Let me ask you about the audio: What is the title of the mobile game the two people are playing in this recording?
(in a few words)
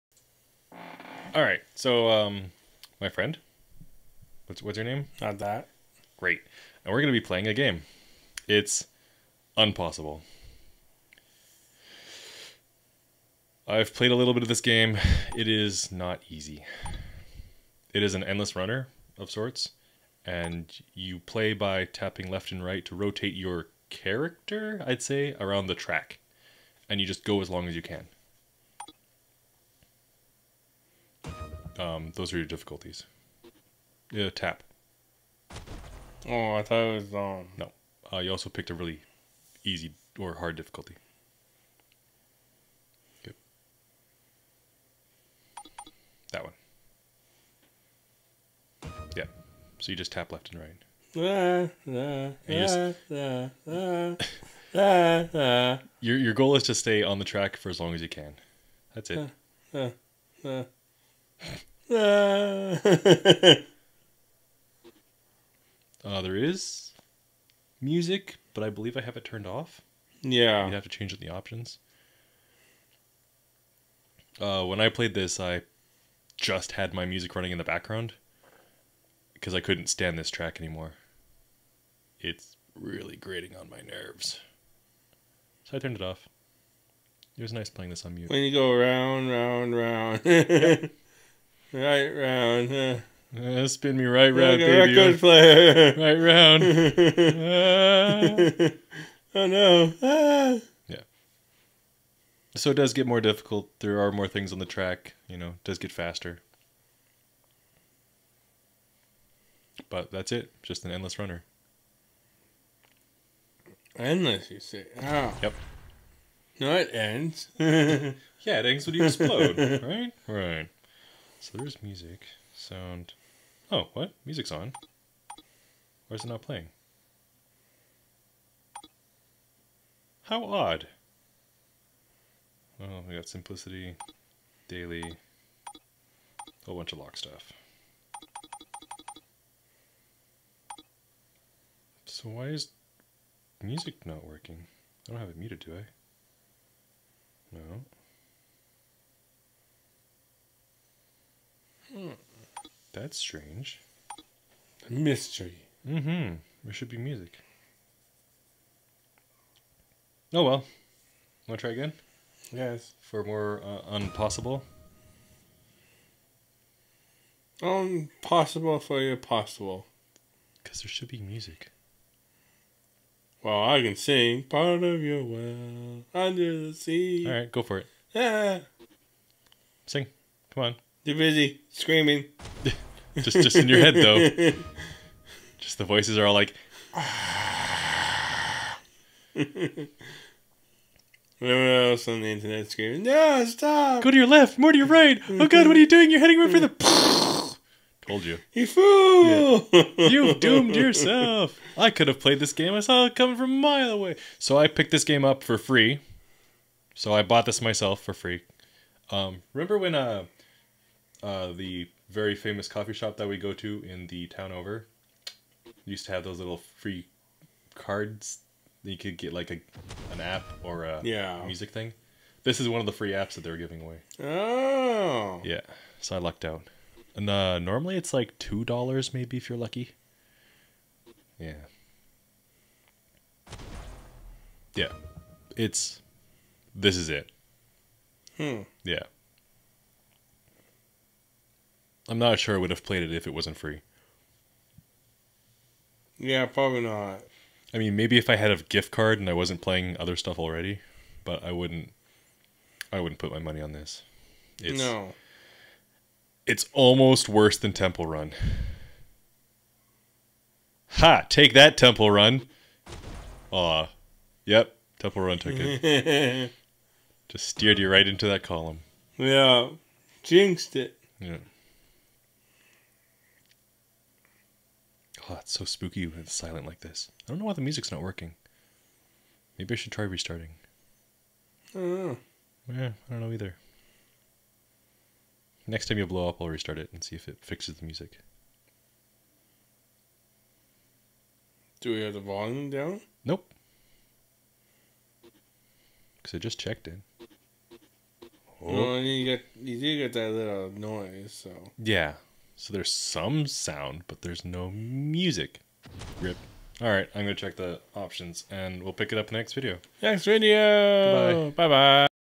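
Unpossible.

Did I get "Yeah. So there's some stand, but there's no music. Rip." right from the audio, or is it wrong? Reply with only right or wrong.
wrong.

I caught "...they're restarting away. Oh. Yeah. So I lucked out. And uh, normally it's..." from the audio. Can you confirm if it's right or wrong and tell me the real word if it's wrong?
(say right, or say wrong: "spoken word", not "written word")
wrong: "giving", not "restarting".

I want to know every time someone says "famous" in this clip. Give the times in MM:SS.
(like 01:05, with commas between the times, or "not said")
03:32.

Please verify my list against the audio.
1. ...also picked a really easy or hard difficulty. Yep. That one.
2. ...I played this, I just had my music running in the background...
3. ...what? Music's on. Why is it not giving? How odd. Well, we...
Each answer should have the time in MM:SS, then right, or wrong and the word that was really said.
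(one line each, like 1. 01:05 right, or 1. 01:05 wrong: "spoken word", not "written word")
1. 00:38 right
2. 01:14 right
3. 02:03 wrong: "playing", not "giving".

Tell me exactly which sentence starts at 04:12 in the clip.
I wouldn't put my money on this.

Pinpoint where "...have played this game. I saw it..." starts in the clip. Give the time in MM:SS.
03:22.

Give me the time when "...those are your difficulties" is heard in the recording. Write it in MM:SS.
00:32.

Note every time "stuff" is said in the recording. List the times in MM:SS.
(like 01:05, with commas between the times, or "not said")
02:17, 04:10.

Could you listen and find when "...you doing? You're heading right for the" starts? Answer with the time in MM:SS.
03:15.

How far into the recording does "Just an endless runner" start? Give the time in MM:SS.
01:50.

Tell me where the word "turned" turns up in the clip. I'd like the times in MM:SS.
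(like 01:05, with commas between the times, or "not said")
01:09, 01:25.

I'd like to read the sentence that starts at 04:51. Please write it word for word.
Do we have the volume down?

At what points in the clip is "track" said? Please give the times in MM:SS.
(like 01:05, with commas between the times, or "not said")
00:25, 00:57, 01:20, 01:44.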